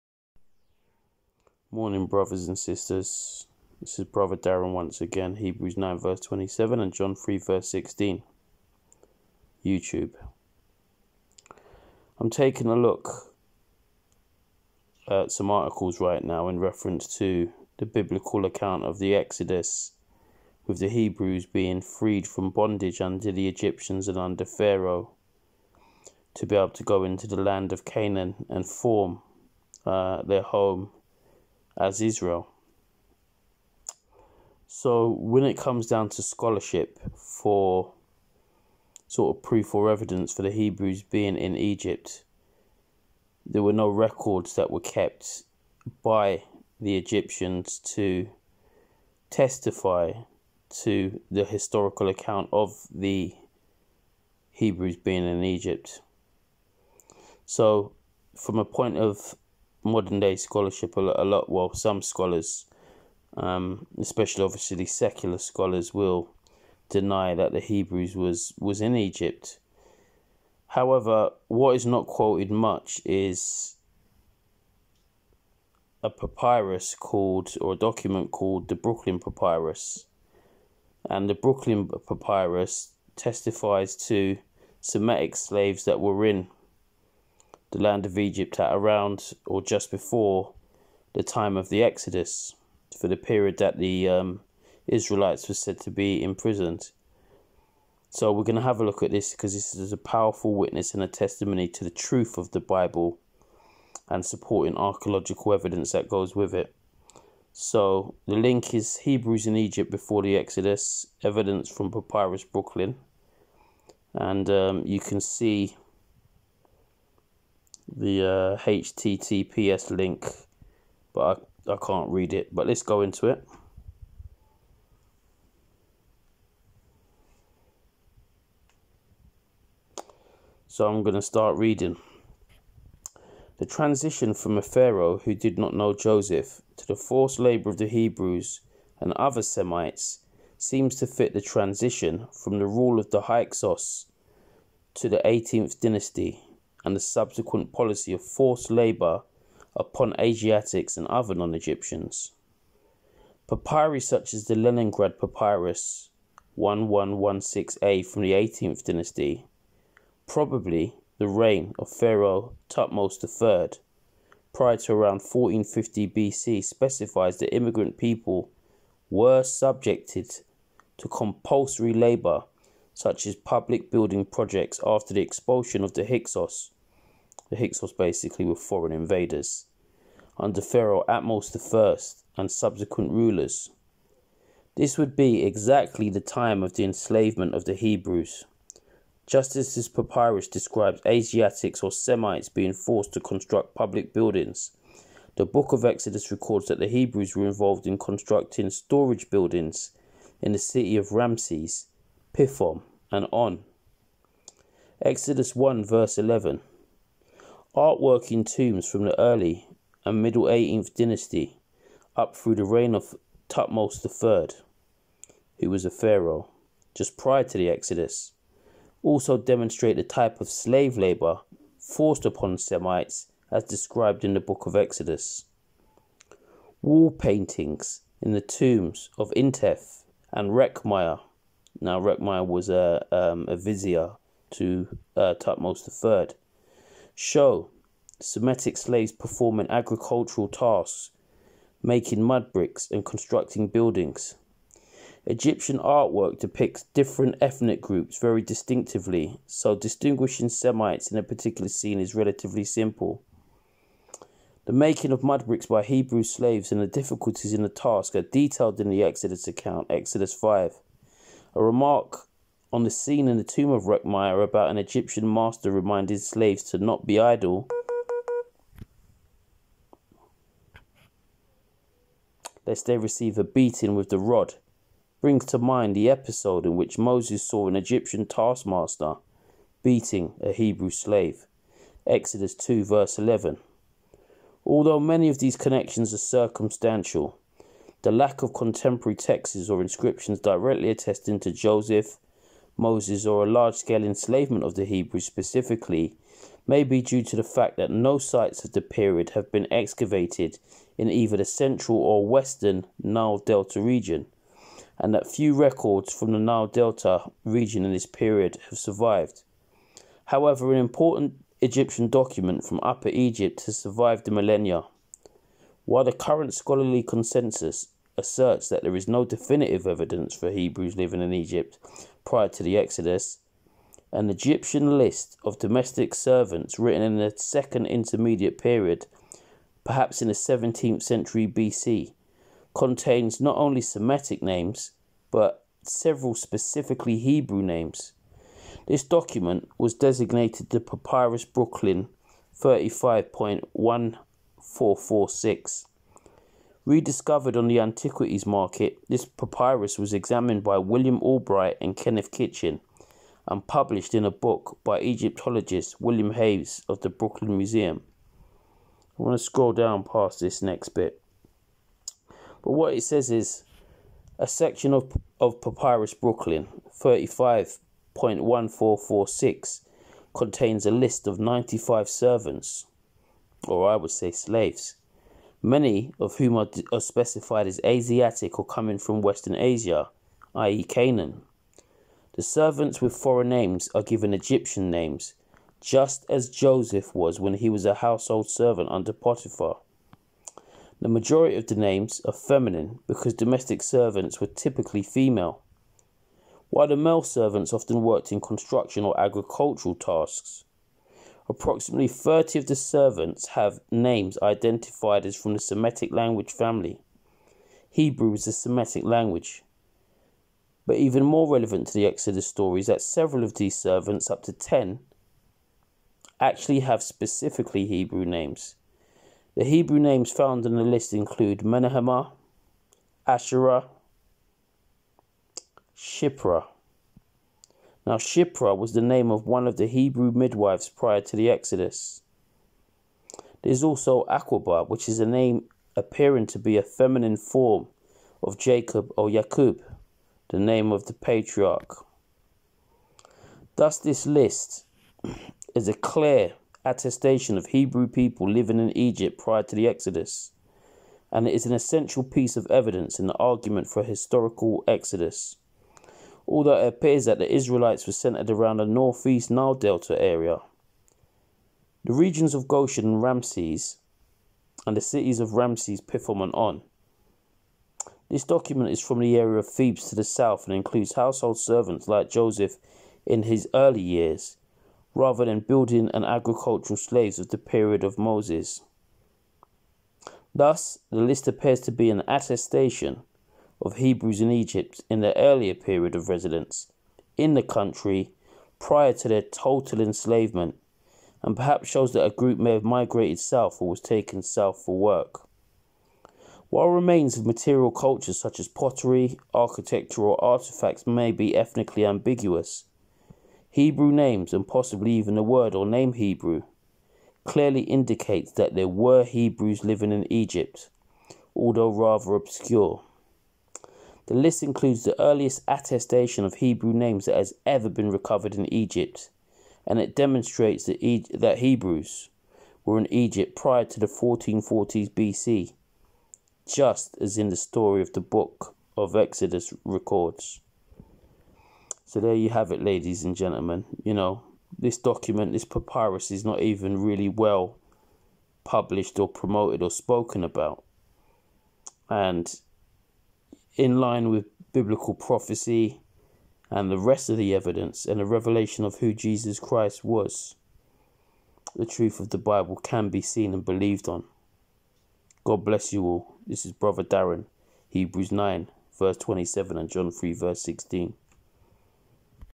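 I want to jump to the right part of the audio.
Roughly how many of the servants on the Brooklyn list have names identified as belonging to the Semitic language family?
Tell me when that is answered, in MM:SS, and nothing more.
06:42.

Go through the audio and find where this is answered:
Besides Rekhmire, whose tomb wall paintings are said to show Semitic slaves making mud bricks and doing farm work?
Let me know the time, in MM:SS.
03:49.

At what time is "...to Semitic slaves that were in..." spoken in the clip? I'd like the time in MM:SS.
01:24.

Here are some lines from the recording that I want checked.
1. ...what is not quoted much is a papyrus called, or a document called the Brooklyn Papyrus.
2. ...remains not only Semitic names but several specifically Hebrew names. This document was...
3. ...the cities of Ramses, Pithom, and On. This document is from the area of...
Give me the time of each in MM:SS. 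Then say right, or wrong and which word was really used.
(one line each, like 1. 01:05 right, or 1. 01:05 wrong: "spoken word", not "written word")
1. 01:11 right
2. 05:32 wrong: "contains", not "remains"
3. 07:44 right.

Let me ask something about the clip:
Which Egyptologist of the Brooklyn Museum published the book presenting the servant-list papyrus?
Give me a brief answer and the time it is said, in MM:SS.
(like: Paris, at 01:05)
William Hayes, at 05:55.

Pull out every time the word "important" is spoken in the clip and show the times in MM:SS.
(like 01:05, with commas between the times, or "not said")
05:10.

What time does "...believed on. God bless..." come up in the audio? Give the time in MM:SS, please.
09:13.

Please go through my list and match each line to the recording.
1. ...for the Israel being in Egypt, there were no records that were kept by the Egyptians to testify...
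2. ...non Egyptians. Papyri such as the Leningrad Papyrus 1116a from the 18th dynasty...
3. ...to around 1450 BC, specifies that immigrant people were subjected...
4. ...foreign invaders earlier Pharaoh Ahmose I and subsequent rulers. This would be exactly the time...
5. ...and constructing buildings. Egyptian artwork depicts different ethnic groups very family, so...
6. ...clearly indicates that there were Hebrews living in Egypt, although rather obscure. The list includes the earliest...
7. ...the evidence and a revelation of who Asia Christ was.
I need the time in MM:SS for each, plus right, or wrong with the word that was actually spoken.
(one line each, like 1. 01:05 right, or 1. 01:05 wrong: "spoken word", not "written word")
1. 00:40 wrong: "Hebrews", not "Israel"
2. 02:31 right
3. 02:44 right
4. 02:58 wrong: "under", not "earlier"
5. 04:02 wrong: "distinctively", not "family"
6. 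08:27 right
7. 09:07 wrong: "Jesus", not "Asia".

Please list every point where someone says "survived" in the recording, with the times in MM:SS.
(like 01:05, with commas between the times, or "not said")
05:08, 05:13.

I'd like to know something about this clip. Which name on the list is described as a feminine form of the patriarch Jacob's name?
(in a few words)
Aquaba.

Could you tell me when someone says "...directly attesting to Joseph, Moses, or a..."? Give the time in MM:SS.
04:50.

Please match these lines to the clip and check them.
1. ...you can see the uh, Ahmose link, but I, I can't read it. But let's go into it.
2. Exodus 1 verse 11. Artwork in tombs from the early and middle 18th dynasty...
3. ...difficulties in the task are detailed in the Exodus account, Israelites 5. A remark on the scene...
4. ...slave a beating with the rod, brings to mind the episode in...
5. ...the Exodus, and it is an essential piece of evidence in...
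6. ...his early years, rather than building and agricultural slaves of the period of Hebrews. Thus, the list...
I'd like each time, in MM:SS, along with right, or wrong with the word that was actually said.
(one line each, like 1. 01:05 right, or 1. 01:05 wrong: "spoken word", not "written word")
1. 01:54 wrong: "HTTPS", not "Ahmose"
2. 03:25 right
3. 04:16 wrong: "Exodus", not "Israelites"
4. 04:32 wrong: "receive", not "slave"
5. 07:29 right
6. 07:53 wrong: "Moses", not "Hebrews".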